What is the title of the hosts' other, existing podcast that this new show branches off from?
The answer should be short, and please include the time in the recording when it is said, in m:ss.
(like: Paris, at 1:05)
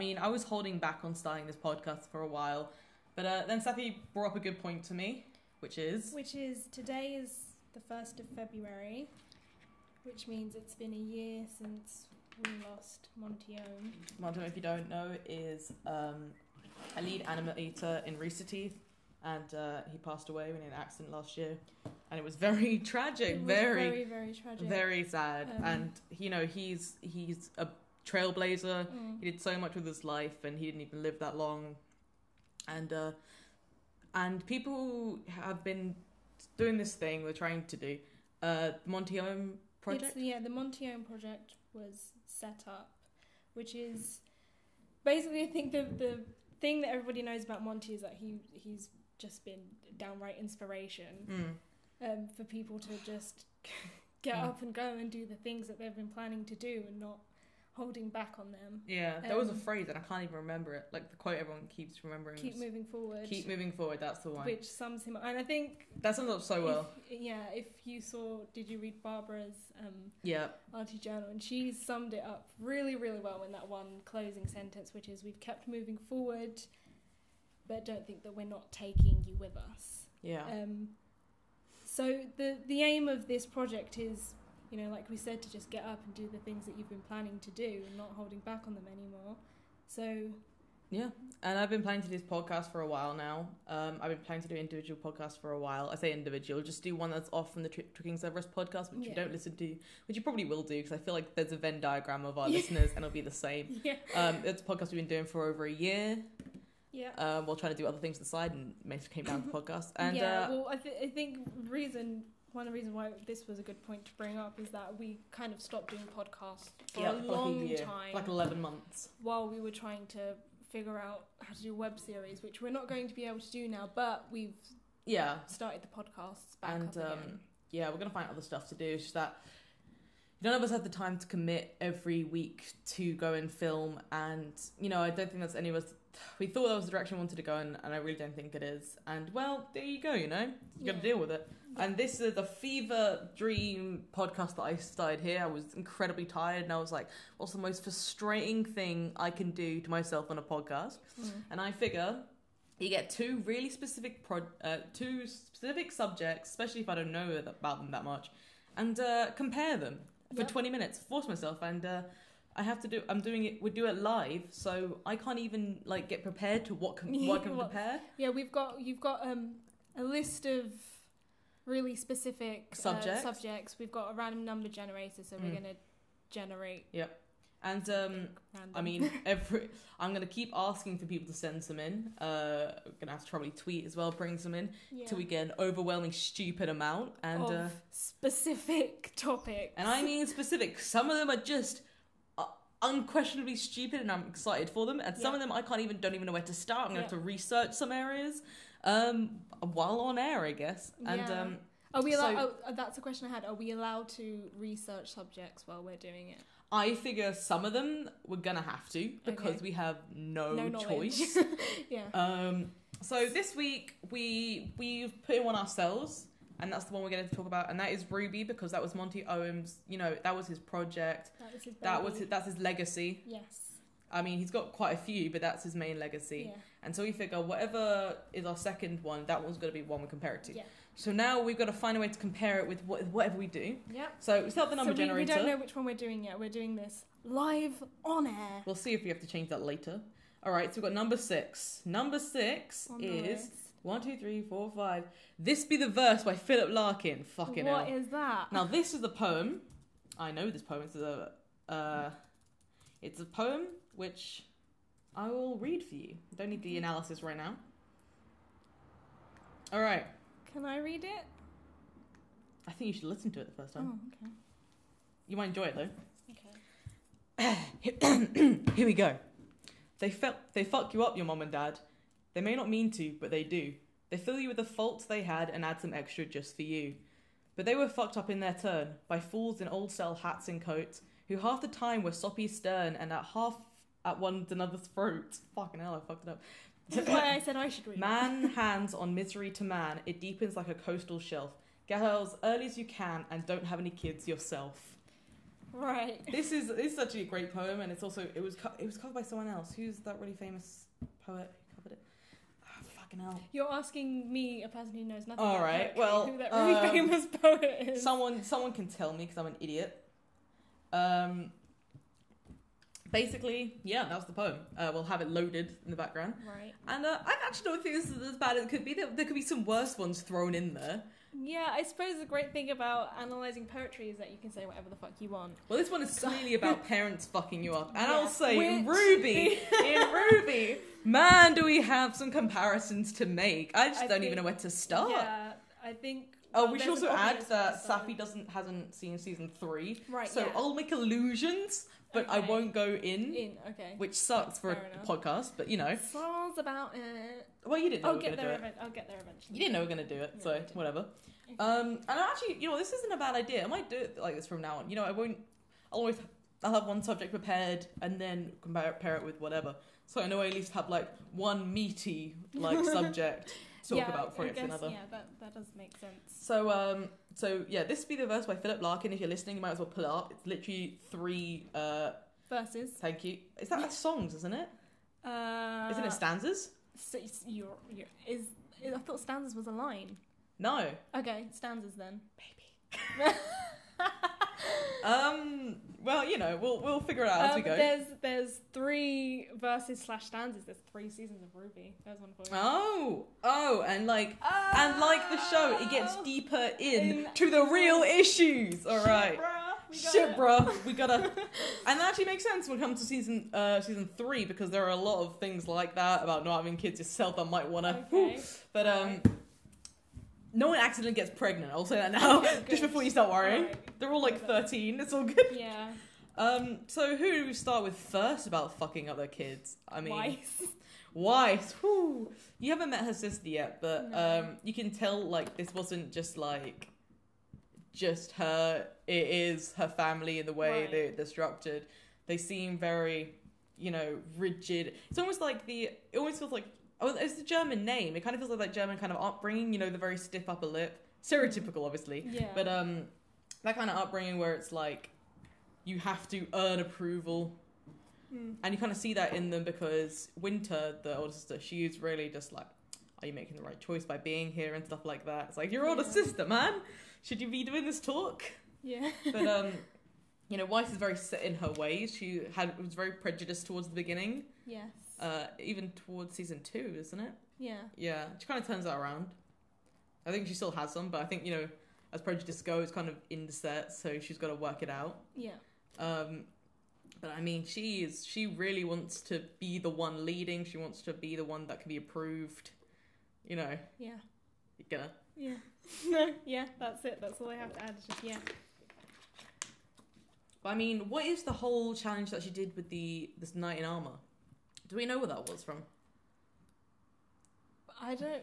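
Tricking Cerberus, at 1:37.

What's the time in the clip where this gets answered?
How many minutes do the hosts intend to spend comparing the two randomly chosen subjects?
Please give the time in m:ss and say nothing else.
2:40.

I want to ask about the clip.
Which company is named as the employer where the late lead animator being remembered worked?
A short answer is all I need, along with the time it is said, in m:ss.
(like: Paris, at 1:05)
Rooster Teeth, at 0:18.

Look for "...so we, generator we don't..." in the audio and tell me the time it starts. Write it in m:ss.
3:54.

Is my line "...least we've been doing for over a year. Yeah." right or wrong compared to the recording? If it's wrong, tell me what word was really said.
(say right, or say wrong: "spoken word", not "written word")
wrong: "podcast", not "least".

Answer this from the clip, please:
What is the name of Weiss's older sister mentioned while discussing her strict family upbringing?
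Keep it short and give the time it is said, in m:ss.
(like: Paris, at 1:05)
Winter, at 7:30.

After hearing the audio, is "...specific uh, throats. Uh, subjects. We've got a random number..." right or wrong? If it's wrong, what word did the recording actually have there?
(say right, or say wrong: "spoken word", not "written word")
wrong: "subjects", not "throats".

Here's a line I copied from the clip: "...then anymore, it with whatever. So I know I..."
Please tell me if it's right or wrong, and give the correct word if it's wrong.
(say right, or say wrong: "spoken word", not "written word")
wrong: "compare", not "anymore".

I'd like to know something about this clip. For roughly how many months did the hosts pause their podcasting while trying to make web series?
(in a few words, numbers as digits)
11.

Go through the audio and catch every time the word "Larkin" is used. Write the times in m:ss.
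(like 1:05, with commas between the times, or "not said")
4:06, 6:08.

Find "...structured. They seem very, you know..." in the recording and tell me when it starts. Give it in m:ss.
7:11.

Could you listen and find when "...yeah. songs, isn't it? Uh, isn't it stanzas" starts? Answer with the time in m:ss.
6:13.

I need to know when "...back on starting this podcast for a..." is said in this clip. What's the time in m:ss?
0:00.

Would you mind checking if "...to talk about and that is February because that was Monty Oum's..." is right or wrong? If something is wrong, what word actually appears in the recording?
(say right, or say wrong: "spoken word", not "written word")
wrong: "RWBY", not "February".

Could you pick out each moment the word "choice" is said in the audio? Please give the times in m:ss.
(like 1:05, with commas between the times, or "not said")
3:30, 7:33.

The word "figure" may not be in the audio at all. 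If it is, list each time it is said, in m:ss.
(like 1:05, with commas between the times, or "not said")
2:00, 2:31, 3:26, 3:47, 6:26.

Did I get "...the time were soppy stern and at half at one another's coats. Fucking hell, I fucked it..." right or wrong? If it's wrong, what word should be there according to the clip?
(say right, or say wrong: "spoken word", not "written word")
wrong: "throats", not "coats".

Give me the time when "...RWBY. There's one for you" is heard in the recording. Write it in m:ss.
6:31.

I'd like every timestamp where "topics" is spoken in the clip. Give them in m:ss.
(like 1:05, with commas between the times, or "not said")
3:09.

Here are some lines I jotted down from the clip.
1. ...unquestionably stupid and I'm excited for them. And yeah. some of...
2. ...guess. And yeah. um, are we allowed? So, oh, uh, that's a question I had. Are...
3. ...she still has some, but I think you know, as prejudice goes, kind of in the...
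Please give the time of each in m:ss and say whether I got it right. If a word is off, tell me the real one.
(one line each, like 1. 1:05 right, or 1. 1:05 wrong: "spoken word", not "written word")
1. 3:12 right
2. 3:20 right
3. 7:50 right.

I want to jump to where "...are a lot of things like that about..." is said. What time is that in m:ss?
6:44.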